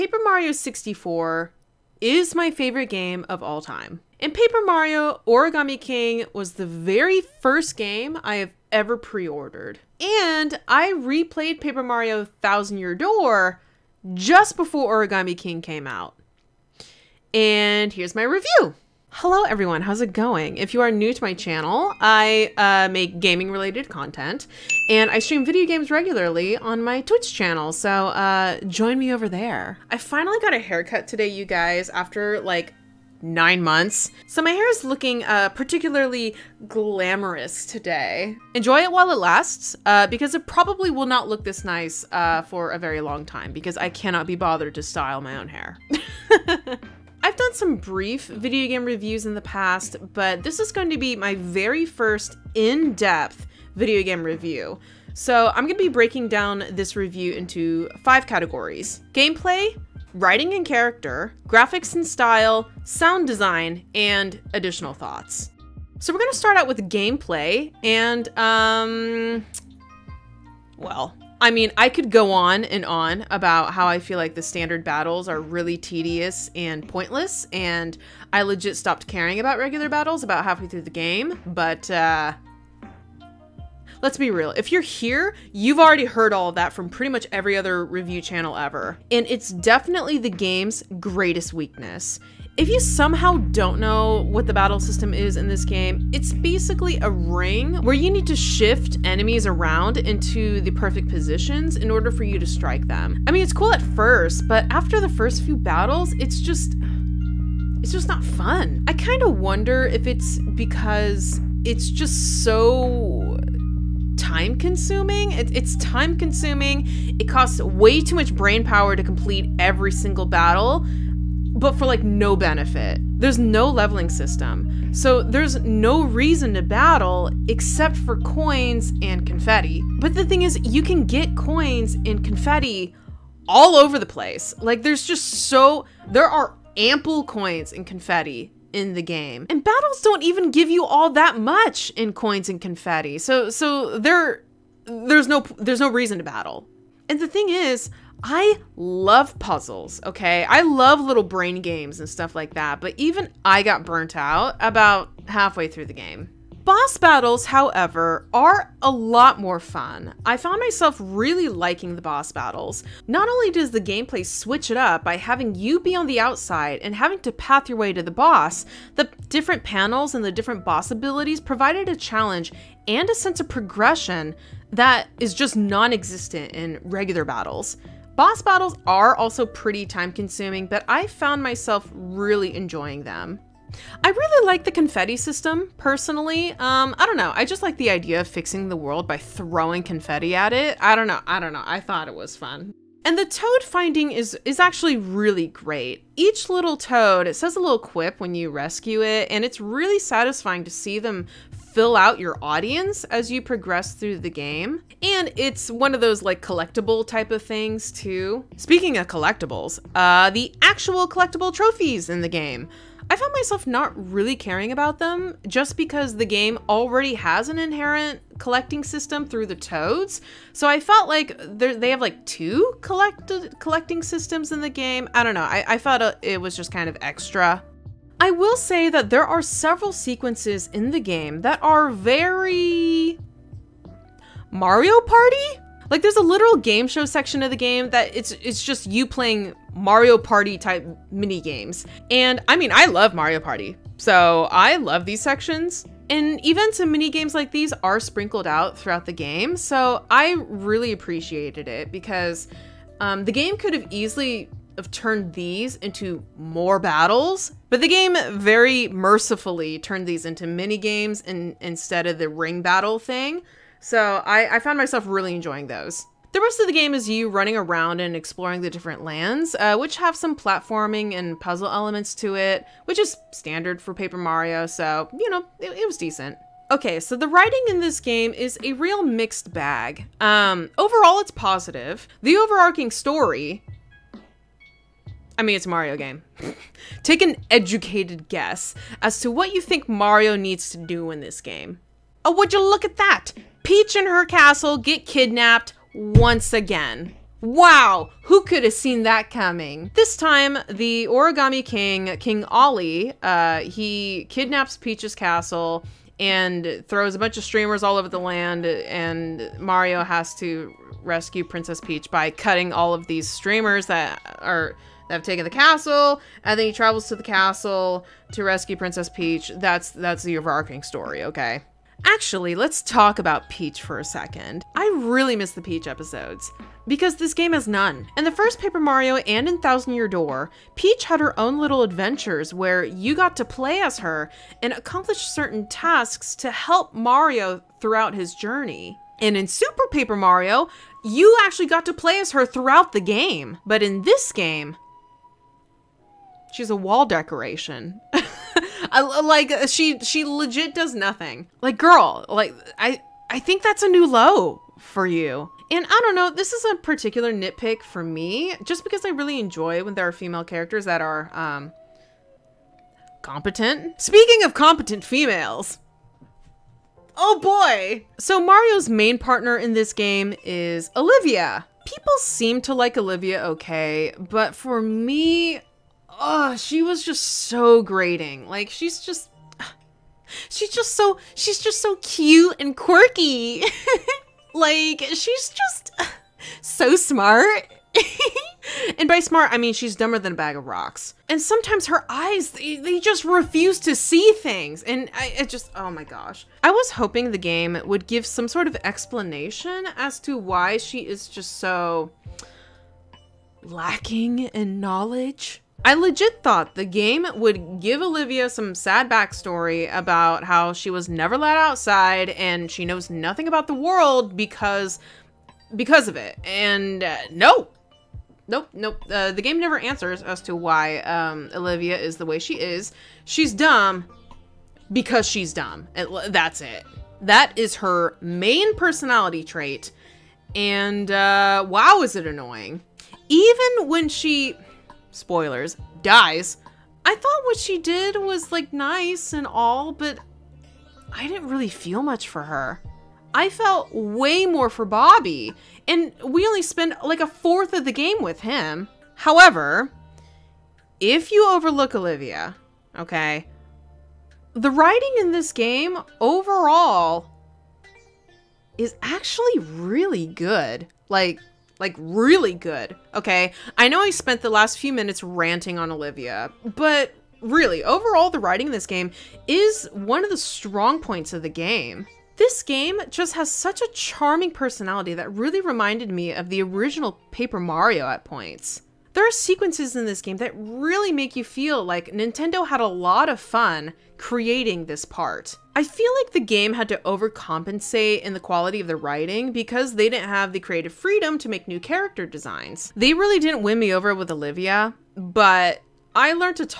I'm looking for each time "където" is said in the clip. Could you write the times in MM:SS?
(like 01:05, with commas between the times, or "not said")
not said.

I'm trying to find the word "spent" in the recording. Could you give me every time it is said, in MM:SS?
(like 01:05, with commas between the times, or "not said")
07:26, 07:44.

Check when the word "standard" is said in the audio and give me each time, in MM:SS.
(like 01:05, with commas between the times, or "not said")
01:14, 04:33.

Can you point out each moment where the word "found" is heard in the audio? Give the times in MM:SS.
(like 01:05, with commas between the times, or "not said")
02:40, 03:01, 03:33, 04:24.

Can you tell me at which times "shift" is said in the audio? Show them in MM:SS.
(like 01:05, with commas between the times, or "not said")
01:38.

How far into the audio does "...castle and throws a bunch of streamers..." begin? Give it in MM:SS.
05:05.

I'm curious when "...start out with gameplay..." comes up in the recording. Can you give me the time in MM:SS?
01:06.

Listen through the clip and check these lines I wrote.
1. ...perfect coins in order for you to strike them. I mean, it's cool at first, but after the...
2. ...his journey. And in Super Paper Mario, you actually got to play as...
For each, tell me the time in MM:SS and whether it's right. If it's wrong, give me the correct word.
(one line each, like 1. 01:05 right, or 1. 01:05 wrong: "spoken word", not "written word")
1. 01:40 wrong: "positions", not "coins"
2. 05:38 right.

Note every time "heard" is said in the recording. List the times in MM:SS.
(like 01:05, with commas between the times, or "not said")
01:26.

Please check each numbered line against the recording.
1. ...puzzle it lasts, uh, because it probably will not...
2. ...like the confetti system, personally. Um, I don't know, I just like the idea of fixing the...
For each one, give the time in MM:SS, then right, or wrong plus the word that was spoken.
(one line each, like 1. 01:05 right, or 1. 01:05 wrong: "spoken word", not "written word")
1. 00:38 wrong: "while", not "puzzle"
2. 03:04 right.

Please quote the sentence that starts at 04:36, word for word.
Okay, so the writing in this game is a real mixed bag.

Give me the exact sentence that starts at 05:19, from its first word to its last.
That's that's the overarching story, okay?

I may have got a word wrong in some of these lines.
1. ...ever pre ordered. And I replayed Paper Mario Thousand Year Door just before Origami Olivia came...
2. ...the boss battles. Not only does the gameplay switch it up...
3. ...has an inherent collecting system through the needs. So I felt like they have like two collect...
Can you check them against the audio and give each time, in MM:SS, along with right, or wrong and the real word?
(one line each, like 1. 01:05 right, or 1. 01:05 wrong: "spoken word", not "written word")
1. 00:08 wrong: "King", not "Olivia"
2. 02:41 right
3. 03:37 wrong: "toads", not "needs".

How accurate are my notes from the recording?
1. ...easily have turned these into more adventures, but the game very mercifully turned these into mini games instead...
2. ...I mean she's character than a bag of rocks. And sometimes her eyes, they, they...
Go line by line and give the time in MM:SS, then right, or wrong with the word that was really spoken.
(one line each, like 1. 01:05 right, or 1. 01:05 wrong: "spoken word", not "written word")
1. 04:13 wrong: "battles", not "adventures"
2. 06:29 wrong: "dumber", not "character".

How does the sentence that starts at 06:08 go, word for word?
So Mario's main partner in this game is Olivia.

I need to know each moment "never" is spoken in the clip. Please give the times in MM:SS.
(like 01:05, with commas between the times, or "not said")
06:51, 06:59.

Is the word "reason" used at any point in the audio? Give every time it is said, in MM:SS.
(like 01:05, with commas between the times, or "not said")
02:06, 02:25.